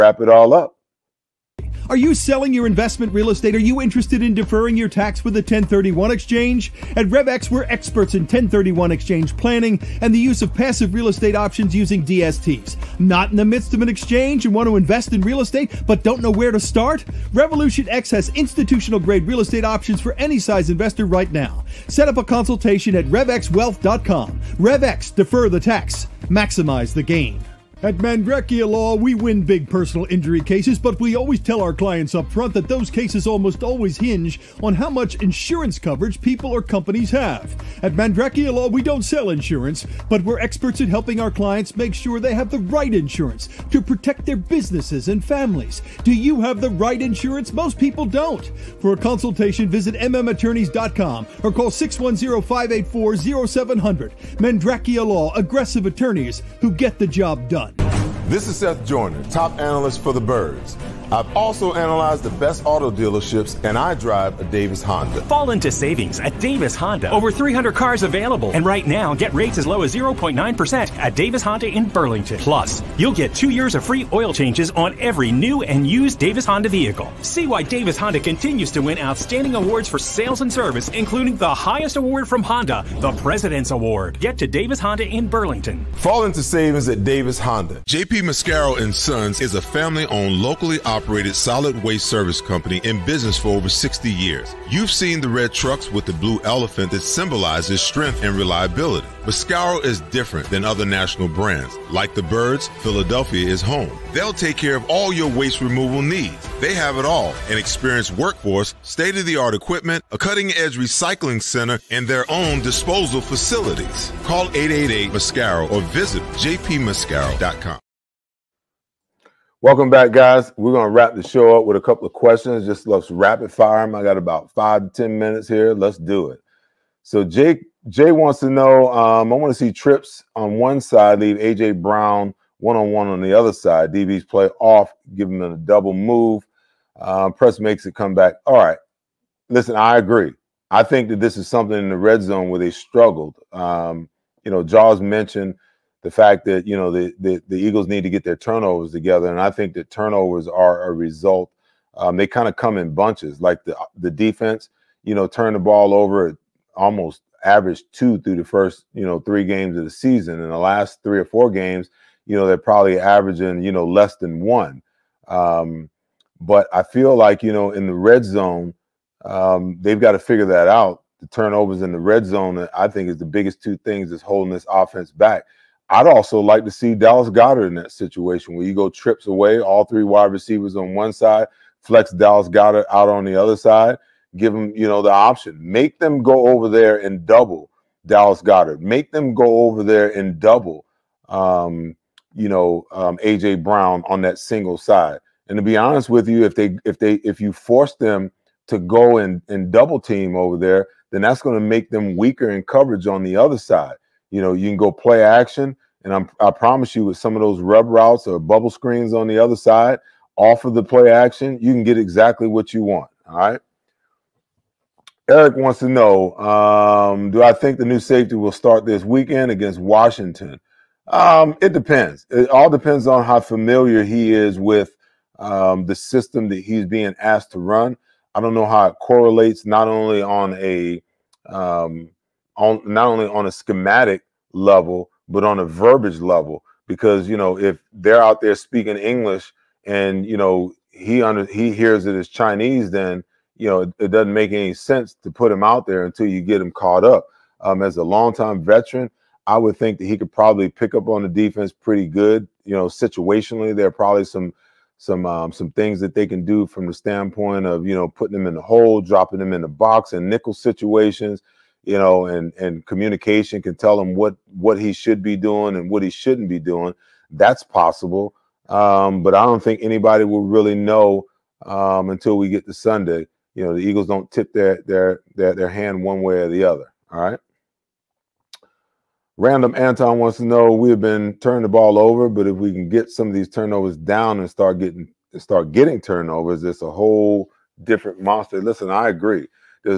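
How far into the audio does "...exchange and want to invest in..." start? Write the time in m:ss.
0:13.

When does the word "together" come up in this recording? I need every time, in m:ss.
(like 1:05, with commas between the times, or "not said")
2:28.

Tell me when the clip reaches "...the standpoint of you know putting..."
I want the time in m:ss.
4:16.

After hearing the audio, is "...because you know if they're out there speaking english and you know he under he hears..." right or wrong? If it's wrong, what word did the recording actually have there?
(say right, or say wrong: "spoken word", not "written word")
right.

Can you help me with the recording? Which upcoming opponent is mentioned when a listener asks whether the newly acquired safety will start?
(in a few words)
Washington.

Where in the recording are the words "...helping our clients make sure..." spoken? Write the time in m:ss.
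0:40.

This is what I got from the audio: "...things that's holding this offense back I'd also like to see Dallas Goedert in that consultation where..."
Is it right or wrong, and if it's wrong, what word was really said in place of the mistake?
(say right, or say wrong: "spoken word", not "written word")
wrong: "situation", not "consultation".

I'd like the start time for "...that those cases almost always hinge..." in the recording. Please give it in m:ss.
0:32.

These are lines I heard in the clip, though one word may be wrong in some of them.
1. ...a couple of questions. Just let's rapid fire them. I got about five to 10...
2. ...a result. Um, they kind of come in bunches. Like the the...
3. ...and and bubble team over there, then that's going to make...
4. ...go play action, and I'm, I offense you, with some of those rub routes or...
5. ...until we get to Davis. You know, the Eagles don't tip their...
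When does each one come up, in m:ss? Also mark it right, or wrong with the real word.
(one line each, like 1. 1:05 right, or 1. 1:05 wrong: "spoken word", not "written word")
1. 2:01 right
2. 2:30 right
3. 3:19 wrong: "double", not "bubble"
4. 3:24 wrong: "promise", not "offense"
5. 4:32 wrong: "Sunday", not "Davis".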